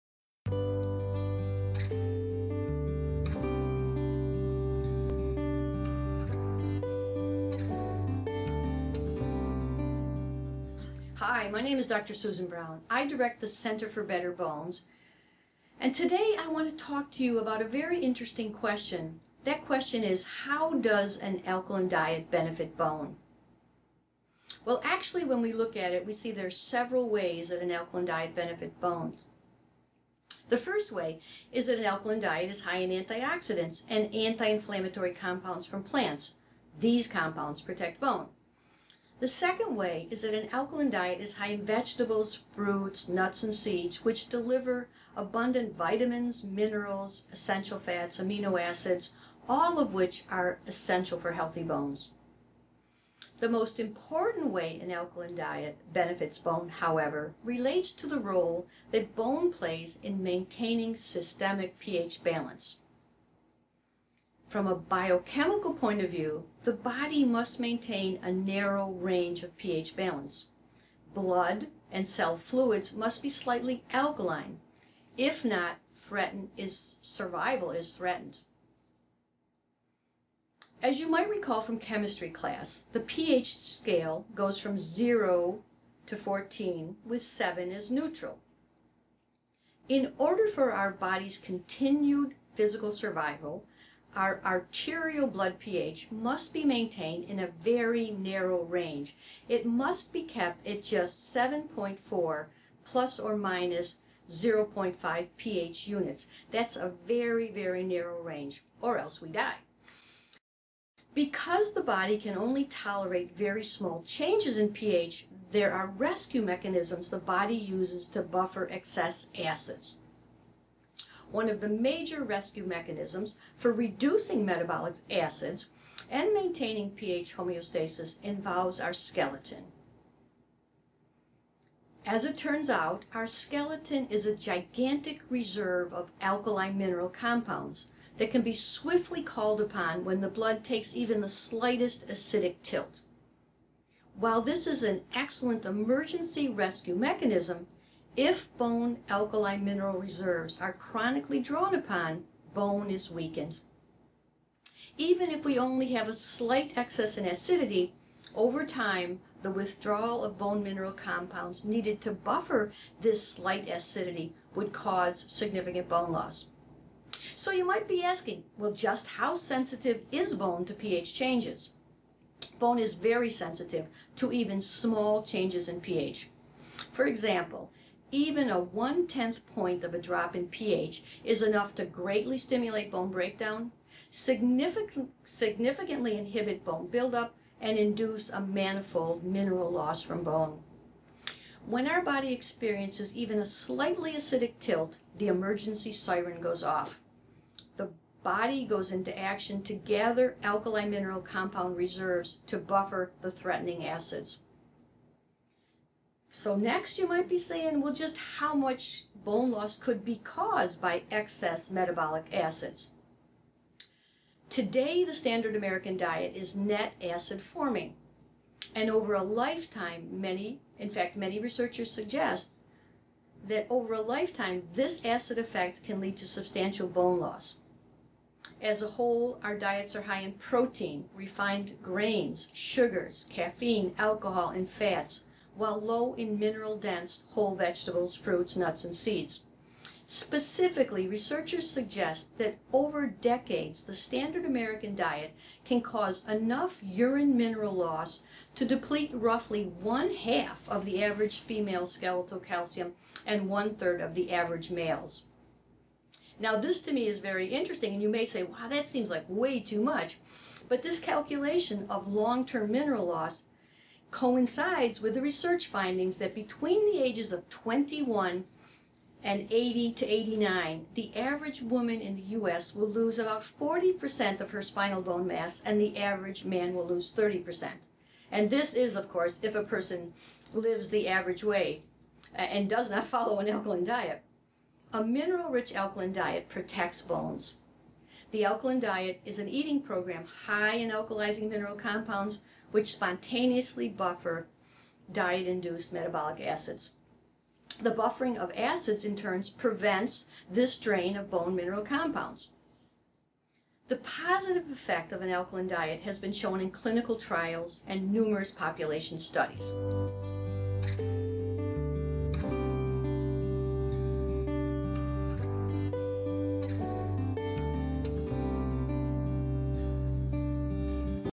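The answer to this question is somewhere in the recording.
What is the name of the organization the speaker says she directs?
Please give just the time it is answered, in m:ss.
0:13.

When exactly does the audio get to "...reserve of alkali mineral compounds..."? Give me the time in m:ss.
2:15.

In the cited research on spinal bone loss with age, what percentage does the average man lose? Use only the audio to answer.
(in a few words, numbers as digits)
30%.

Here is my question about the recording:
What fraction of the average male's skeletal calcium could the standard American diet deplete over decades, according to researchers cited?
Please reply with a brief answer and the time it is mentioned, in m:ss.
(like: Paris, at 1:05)
one third, at 4:13.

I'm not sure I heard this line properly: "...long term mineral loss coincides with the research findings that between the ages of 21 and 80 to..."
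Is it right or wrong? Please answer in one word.
right.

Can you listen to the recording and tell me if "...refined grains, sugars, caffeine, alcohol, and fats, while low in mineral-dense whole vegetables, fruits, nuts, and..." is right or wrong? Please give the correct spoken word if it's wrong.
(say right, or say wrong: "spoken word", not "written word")
right.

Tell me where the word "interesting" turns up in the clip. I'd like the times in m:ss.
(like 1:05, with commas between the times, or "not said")
0:17, 4:17.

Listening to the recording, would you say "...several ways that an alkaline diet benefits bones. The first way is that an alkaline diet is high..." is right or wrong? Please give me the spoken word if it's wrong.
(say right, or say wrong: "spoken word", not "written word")
right.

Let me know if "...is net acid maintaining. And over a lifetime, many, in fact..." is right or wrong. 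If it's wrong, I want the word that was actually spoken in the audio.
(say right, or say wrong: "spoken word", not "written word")
wrong: "forming", not "maintaining".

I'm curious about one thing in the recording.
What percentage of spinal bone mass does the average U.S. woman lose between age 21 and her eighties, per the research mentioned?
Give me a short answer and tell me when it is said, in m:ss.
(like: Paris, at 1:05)
40%, at 4:33.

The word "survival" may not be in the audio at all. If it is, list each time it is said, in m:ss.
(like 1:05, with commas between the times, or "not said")
1:17, 1:32.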